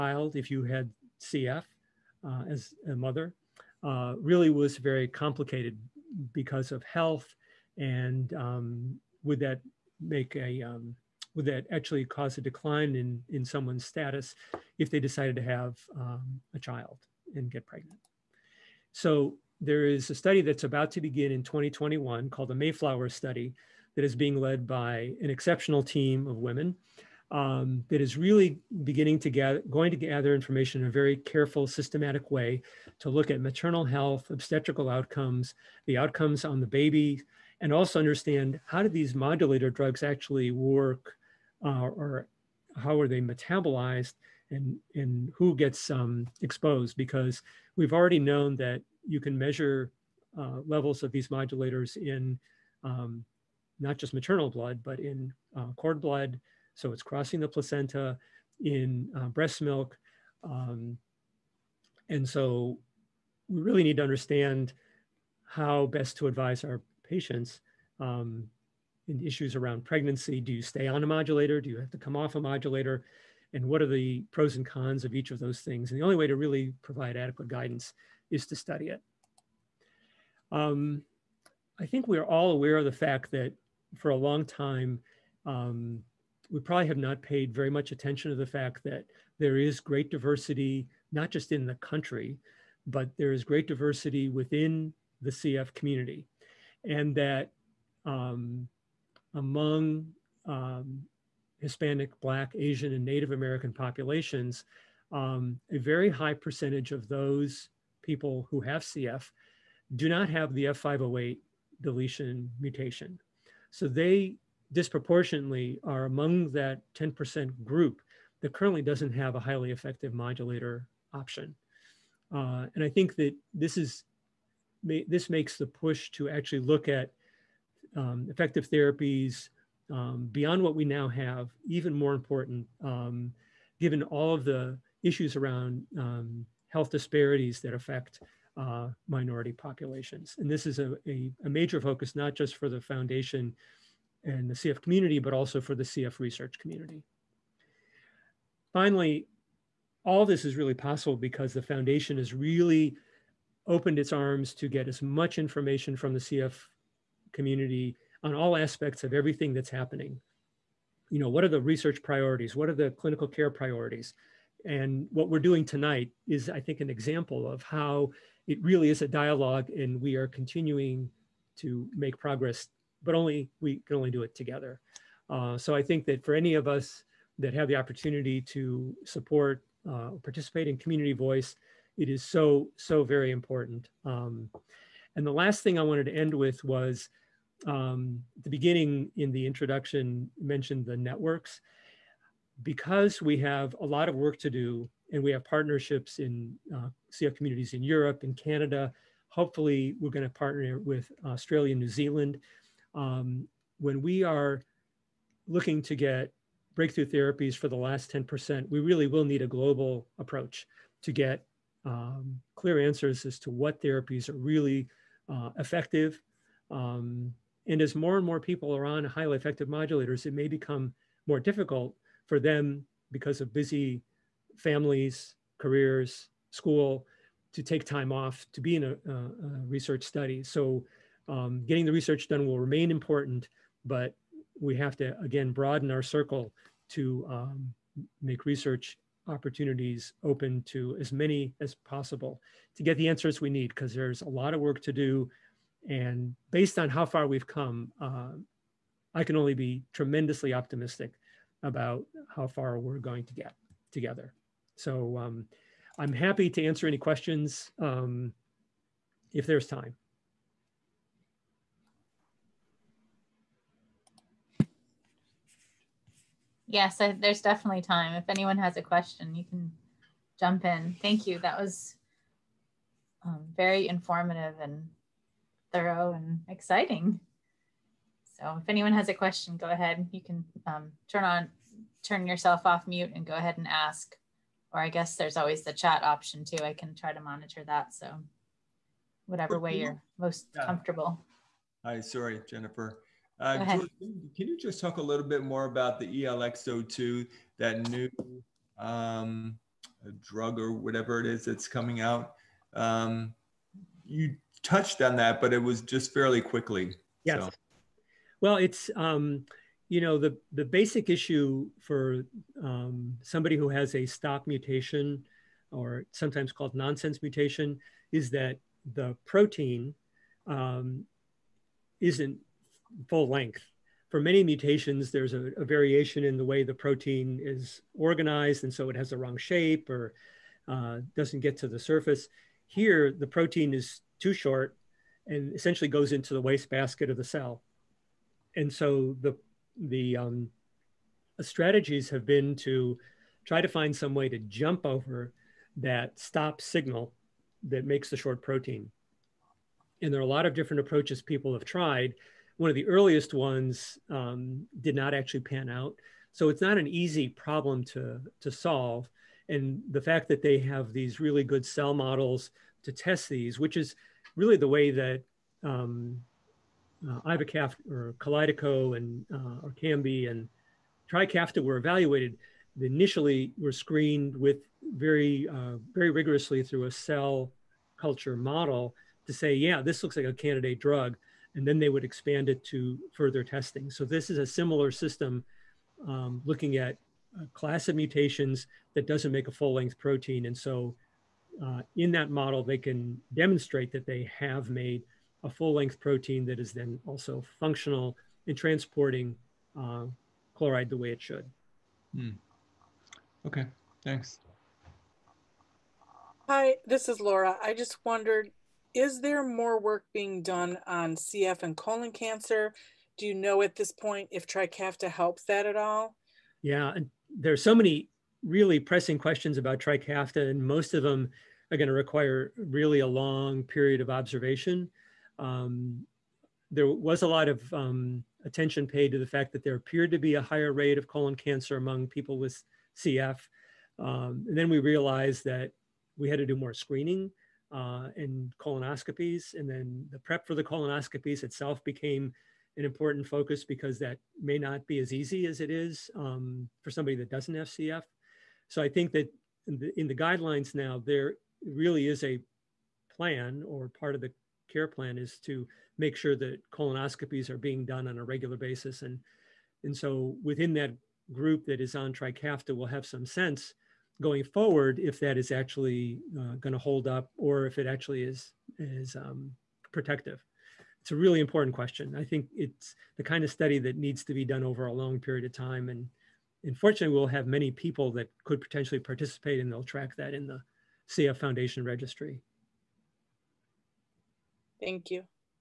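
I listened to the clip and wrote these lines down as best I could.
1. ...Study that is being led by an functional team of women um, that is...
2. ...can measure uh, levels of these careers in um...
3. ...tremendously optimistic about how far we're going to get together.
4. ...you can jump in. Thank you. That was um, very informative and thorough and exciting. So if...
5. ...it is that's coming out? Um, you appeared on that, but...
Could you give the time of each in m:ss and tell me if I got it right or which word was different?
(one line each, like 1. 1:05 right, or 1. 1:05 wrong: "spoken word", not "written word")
1. 0:23 wrong: "exceptional", not "functional"
2. 0:49 wrong: "modulators", not "careers"
3. 4:09 right
4. 4:29 right
5. 5:01 wrong: "touched", not "appeared".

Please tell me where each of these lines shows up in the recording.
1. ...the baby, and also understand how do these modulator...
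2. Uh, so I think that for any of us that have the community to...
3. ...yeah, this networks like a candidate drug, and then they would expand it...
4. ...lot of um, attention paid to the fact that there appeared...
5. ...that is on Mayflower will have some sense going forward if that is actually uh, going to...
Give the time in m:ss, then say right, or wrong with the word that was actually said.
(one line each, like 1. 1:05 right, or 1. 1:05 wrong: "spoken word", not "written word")
1. 0:36 right
2. 2:55 wrong: "opportunity", not "community"
3. 6:19 wrong: "looks", not "networks"
4. 7:07 right
5. 7:41 wrong: "Trikafta", not "Mayflower".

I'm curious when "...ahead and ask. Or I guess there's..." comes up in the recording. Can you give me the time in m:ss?
4:43.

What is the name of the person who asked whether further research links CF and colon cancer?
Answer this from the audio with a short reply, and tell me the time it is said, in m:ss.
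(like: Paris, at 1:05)
Laura, at 6:47.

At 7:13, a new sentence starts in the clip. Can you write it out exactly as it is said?
Um, and then we realized that we had to do more screening uh, and colonoscopies.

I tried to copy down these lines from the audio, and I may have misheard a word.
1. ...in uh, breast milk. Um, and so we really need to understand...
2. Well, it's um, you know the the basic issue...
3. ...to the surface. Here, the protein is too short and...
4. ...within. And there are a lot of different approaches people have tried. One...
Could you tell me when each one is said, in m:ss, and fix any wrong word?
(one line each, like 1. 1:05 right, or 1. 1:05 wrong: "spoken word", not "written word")
1. 0:58 right
2. 5:08 right
3. 5:31 right
4. 5:48 wrong: "protein", not "within".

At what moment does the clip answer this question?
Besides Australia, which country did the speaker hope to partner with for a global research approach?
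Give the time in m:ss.
3:21.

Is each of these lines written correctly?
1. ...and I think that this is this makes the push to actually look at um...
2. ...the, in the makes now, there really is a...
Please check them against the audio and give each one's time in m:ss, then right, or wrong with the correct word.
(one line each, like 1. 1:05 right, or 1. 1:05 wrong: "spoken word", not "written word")
1. 2:02 right
2. 7:29 wrong: "guidelines", not "makes".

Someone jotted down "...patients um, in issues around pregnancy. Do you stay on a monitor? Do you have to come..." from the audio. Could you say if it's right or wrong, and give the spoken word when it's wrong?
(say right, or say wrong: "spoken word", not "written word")
wrong: "modulator", not "monitor".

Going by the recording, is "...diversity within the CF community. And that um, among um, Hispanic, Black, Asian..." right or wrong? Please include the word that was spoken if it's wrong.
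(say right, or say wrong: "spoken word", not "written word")
right.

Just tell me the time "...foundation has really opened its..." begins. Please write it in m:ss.
2:31.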